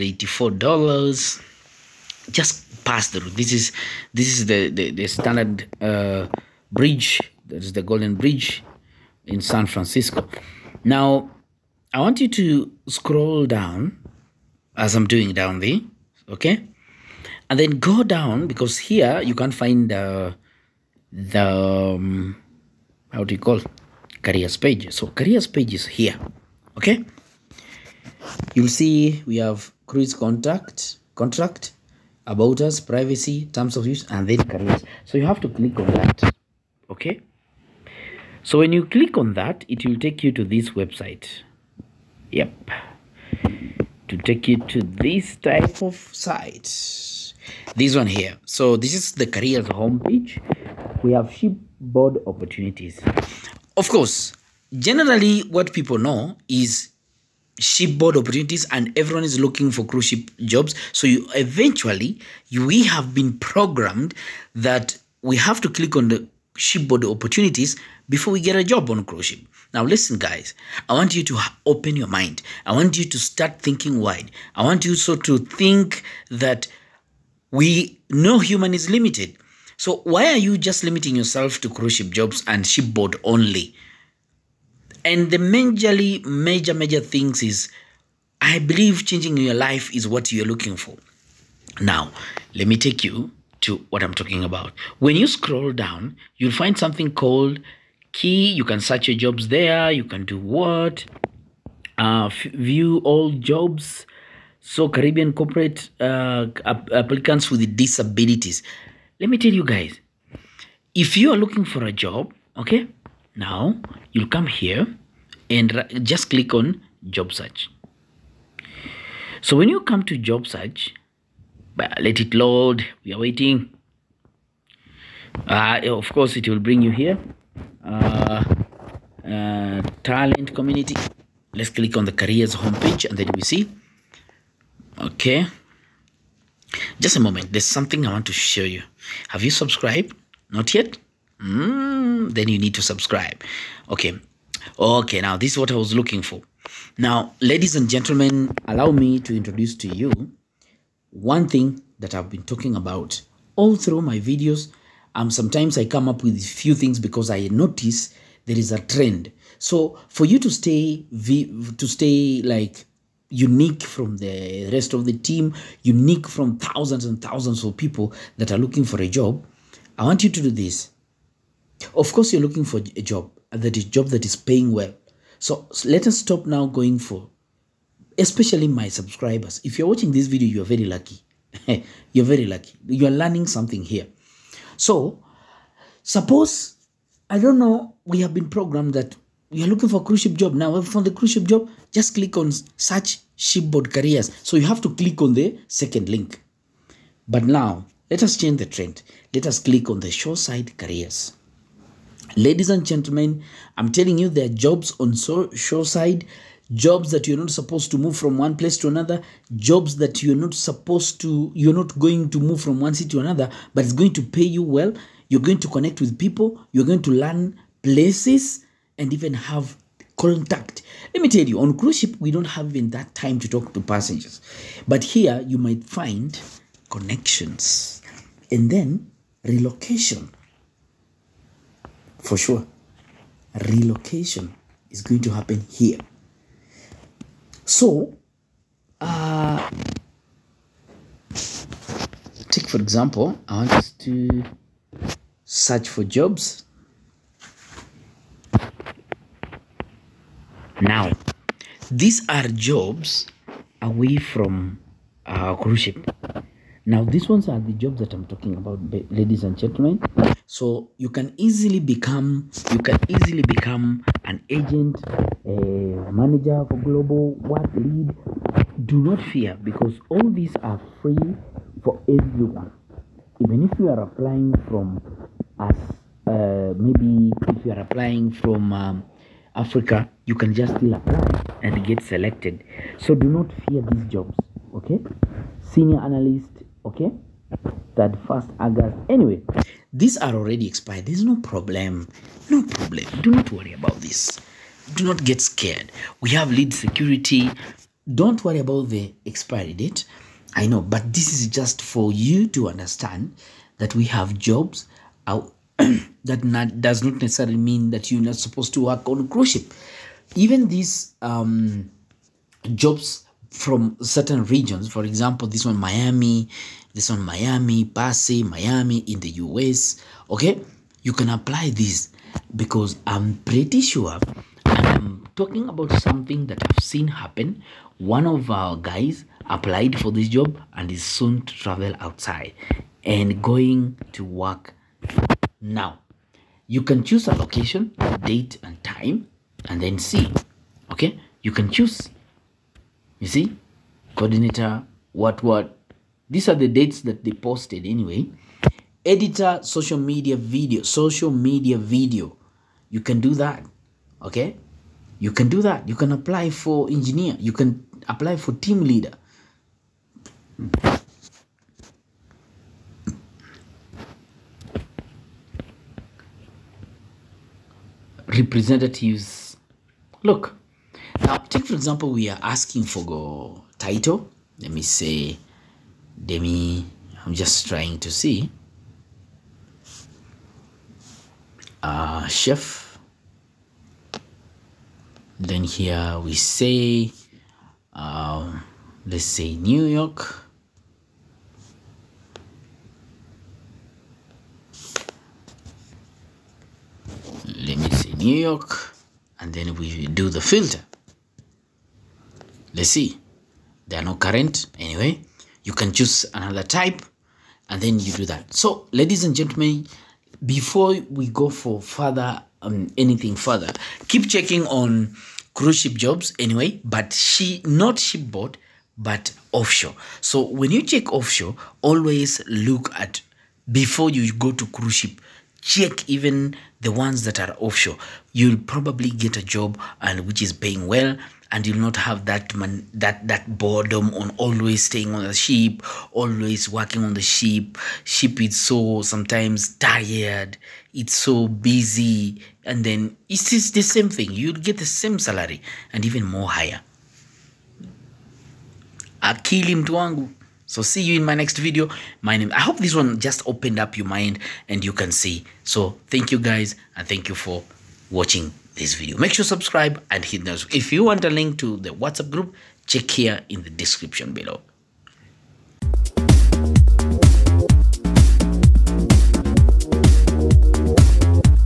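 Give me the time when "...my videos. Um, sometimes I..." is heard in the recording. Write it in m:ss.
2:34.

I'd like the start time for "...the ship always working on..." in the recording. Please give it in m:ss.
7:15.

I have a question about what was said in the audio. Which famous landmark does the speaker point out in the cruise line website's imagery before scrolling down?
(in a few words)
Golden Bridge.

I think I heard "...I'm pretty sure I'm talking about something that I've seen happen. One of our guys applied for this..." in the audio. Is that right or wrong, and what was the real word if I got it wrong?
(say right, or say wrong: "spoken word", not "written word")
right.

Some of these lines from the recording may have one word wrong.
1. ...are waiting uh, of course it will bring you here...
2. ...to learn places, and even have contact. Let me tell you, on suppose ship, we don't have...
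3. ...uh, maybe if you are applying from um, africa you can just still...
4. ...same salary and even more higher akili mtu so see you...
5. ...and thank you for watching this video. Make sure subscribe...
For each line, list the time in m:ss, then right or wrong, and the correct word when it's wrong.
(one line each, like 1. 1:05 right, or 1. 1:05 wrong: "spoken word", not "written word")
1. 2:03 right
2. 3:37 wrong: "cruise", not "suppose"
3. 4:36 right
4. 7:24 right
5. 7:36 right.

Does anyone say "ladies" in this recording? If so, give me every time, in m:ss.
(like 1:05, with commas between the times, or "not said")
2:27, 3:22, 4:19, 6:48.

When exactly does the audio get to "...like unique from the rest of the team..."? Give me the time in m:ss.
2:42.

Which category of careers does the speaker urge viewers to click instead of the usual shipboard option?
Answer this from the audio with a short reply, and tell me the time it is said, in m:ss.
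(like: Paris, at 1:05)
shoreside careers, at 3:20.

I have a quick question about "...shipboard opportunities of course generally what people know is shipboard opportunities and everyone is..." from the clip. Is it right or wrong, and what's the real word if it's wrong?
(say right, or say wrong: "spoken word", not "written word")
right.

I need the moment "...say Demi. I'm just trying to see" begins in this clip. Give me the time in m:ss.
6:14.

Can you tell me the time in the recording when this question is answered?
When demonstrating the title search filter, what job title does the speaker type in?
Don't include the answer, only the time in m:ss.
6:22.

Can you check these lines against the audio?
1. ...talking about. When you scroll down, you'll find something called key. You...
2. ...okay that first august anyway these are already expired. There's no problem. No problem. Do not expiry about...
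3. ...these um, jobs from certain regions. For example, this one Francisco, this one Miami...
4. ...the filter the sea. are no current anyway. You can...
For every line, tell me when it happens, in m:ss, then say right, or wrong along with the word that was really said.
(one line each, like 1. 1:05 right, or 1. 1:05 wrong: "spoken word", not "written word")
1. 1:34 right
2. 4:46 wrong: "worry", not "expiry"
3. 5:10 wrong: "Miami", not "Francisco"
4. 6:40 right.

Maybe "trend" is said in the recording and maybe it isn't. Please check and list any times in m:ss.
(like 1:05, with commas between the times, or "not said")
2:38, 3:18.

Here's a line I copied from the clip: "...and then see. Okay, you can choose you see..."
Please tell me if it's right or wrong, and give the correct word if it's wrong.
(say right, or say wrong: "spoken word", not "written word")
right.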